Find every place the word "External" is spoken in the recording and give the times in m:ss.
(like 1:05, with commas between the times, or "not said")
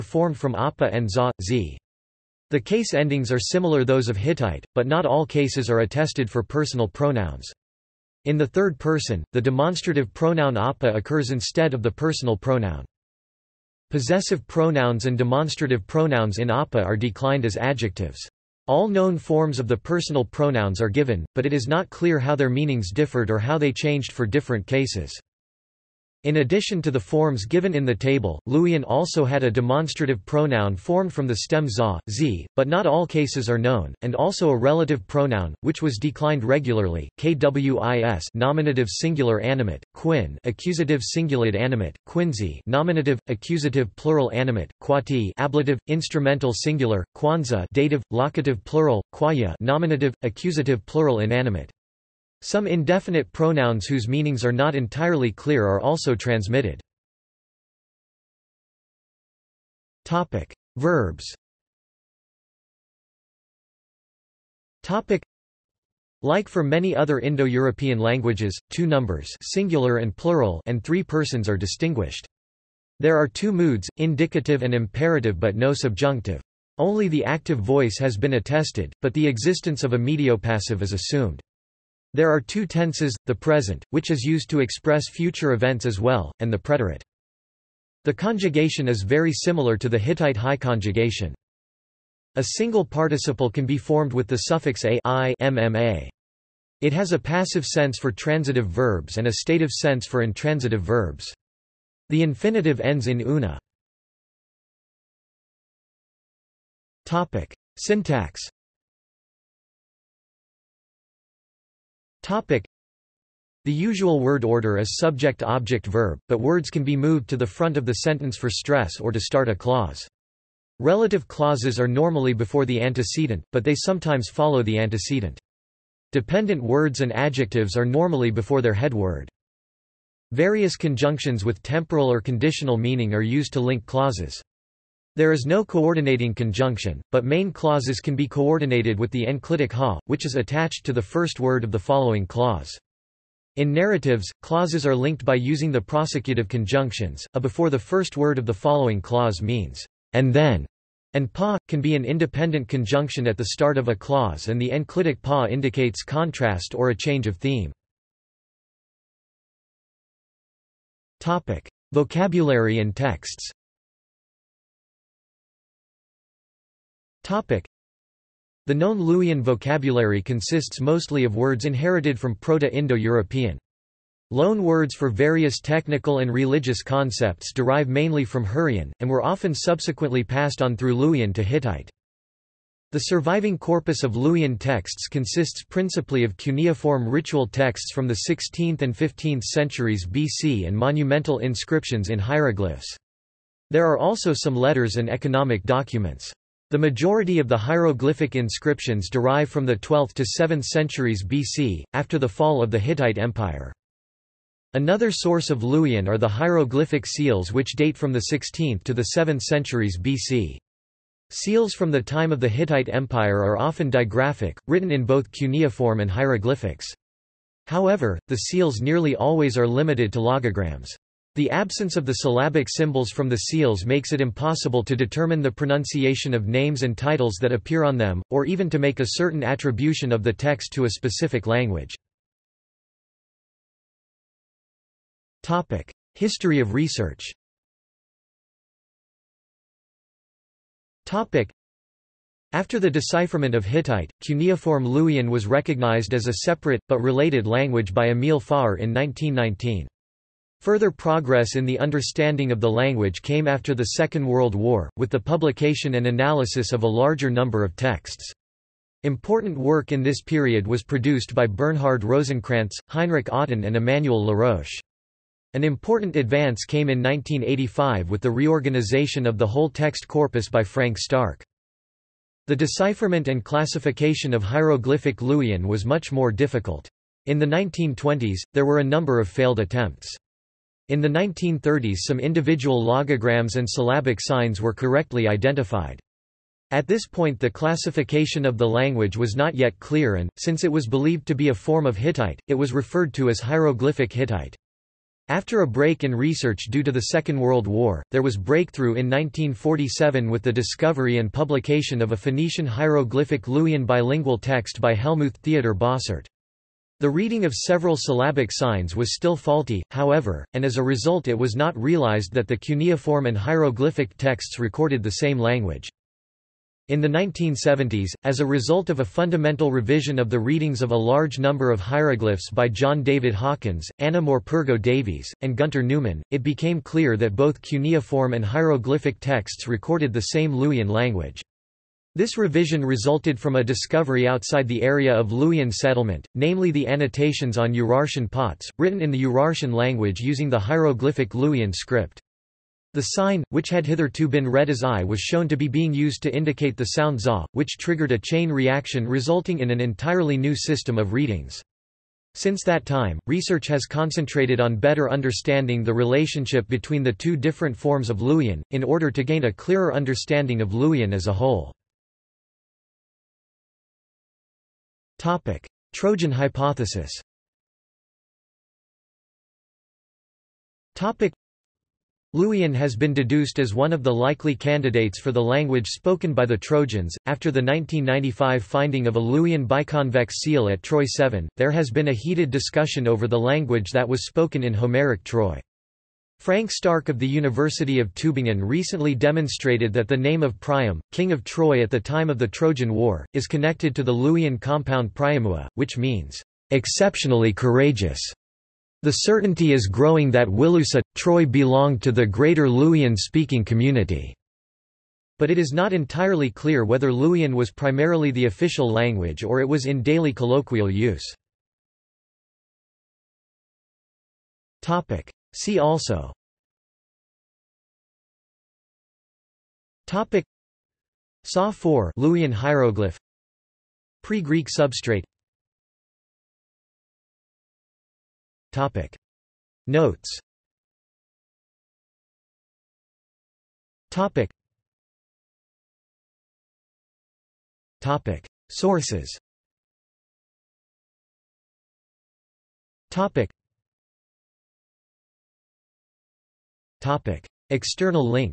7:27.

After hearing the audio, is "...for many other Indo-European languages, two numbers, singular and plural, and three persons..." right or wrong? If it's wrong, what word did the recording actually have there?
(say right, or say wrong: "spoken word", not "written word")
right.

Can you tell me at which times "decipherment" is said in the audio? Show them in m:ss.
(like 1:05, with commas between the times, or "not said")
4:02, 4:32.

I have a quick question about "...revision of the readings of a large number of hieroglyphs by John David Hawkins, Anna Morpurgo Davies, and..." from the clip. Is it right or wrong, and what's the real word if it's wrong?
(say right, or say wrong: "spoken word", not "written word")
right.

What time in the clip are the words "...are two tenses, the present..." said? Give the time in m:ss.
1:22.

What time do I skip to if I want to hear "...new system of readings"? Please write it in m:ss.
5:50.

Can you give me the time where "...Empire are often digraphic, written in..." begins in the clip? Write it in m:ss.
3:32.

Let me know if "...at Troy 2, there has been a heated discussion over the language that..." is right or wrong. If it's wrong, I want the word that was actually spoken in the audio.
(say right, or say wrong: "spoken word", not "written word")
wrong: "7", not "2".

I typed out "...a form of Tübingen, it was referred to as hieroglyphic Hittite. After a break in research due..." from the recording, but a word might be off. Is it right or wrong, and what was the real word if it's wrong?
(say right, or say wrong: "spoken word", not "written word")
wrong: "Hittite", not "Tübingen".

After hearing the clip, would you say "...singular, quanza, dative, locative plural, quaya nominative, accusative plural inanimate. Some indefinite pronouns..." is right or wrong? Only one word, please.
right.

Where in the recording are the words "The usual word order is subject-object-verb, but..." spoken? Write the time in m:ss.
1:53.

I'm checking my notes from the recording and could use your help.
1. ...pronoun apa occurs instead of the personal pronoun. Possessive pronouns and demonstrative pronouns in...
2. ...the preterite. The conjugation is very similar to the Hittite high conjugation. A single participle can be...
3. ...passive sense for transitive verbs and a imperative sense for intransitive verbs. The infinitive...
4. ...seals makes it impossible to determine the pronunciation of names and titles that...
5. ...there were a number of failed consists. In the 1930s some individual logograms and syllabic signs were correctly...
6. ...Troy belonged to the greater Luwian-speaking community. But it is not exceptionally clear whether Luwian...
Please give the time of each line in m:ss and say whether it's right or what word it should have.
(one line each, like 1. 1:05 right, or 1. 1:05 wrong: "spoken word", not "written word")
1. 0:10 right
2. 1:26 right
3. 1:37 wrong: "stative", not "imperative"
4. 3:43 right
5. 4:38 wrong: "attempts", not "consists"
6. 6:41 wrong: "entirely", not "exceptionally".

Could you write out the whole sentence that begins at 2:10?
Various conjunctions with temporal or conditional meaning are used to link clauses.